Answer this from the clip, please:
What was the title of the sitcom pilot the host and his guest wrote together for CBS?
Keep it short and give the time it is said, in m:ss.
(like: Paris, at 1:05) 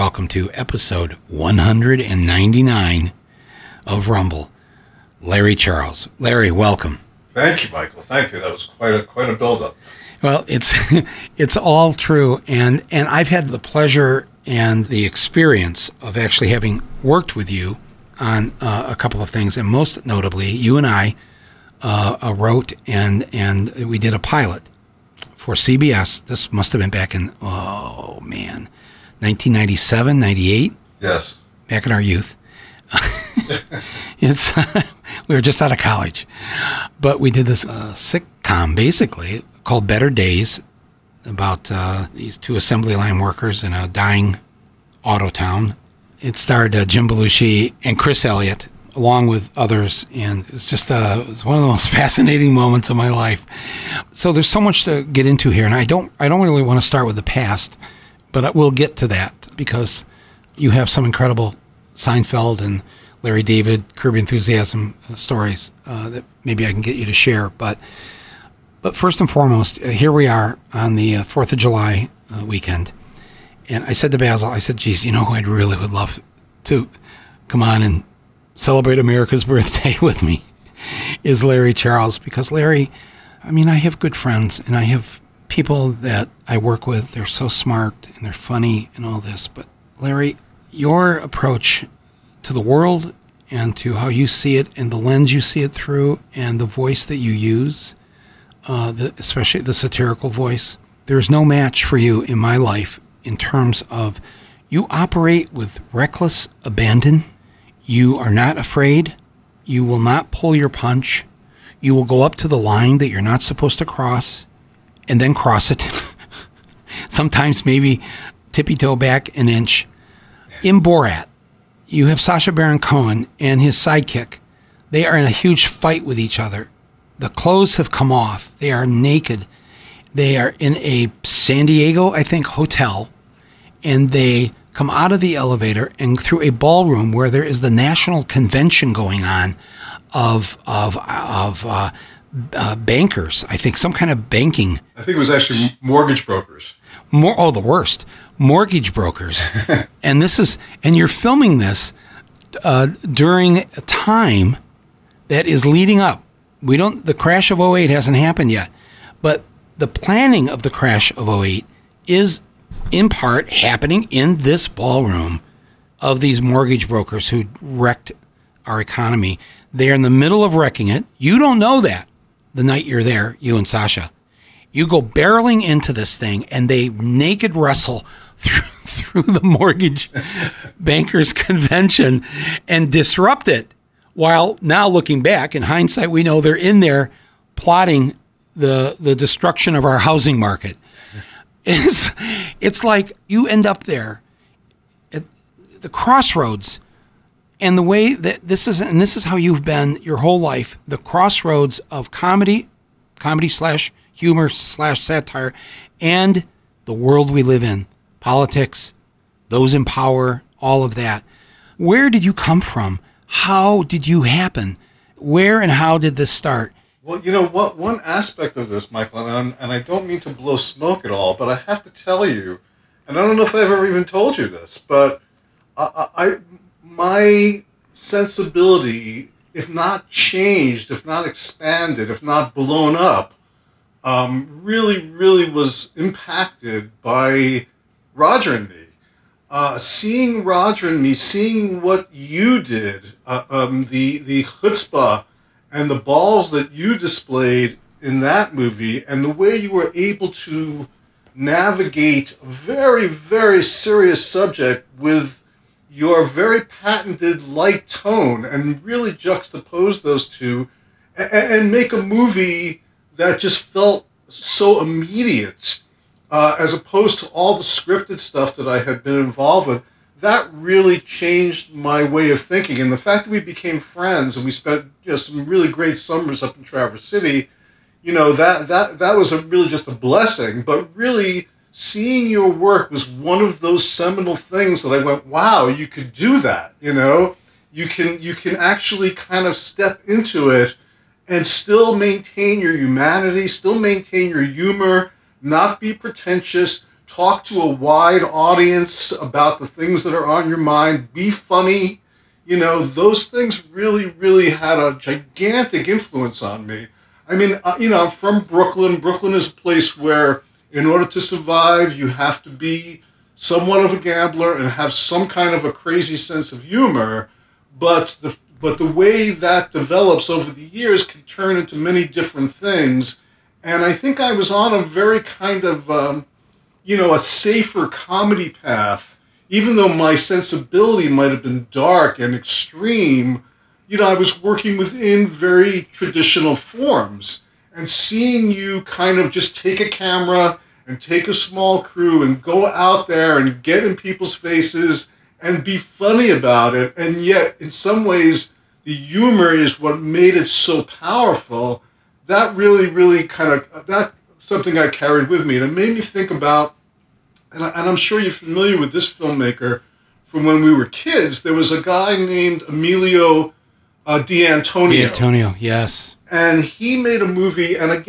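Better Days, at 0:39.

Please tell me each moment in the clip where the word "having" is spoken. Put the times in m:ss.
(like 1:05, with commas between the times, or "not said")
0:16.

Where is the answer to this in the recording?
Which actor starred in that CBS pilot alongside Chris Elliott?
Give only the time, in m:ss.
0:46.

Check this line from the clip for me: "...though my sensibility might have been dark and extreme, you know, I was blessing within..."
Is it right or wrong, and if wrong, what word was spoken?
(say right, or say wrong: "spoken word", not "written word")
wrong: "working", not "blessing".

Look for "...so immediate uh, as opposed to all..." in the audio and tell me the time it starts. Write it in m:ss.
4:24.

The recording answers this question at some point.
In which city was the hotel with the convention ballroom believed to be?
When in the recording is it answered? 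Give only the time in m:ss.
2:11.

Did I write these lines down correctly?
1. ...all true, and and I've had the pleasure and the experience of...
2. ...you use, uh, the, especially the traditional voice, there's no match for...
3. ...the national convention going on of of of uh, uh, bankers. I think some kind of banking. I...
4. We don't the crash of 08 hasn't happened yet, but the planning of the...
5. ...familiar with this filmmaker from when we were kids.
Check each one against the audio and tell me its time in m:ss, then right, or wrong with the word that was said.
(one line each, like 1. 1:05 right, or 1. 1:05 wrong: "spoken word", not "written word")
1. 0:11 right
2. 1:37 wrong: "satirical", not "traditional"
3. 2:17 right
4. 2:36 right
5. 5:58 right.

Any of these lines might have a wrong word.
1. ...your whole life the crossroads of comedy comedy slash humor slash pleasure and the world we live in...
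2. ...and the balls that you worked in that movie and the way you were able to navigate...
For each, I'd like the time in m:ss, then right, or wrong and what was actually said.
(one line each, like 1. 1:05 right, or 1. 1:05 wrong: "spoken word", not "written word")
1. 3:20 wrong: "satire", not "pleasure"
2. 4:05 wrong: "displayed", not "worked".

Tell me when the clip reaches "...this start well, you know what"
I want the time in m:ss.
3:36.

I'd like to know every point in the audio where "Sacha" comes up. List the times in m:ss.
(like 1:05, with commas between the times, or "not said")
2:02, 2:53.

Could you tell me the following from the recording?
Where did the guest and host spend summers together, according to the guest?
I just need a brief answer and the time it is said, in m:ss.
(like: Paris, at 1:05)
Traverse City, at 4:36.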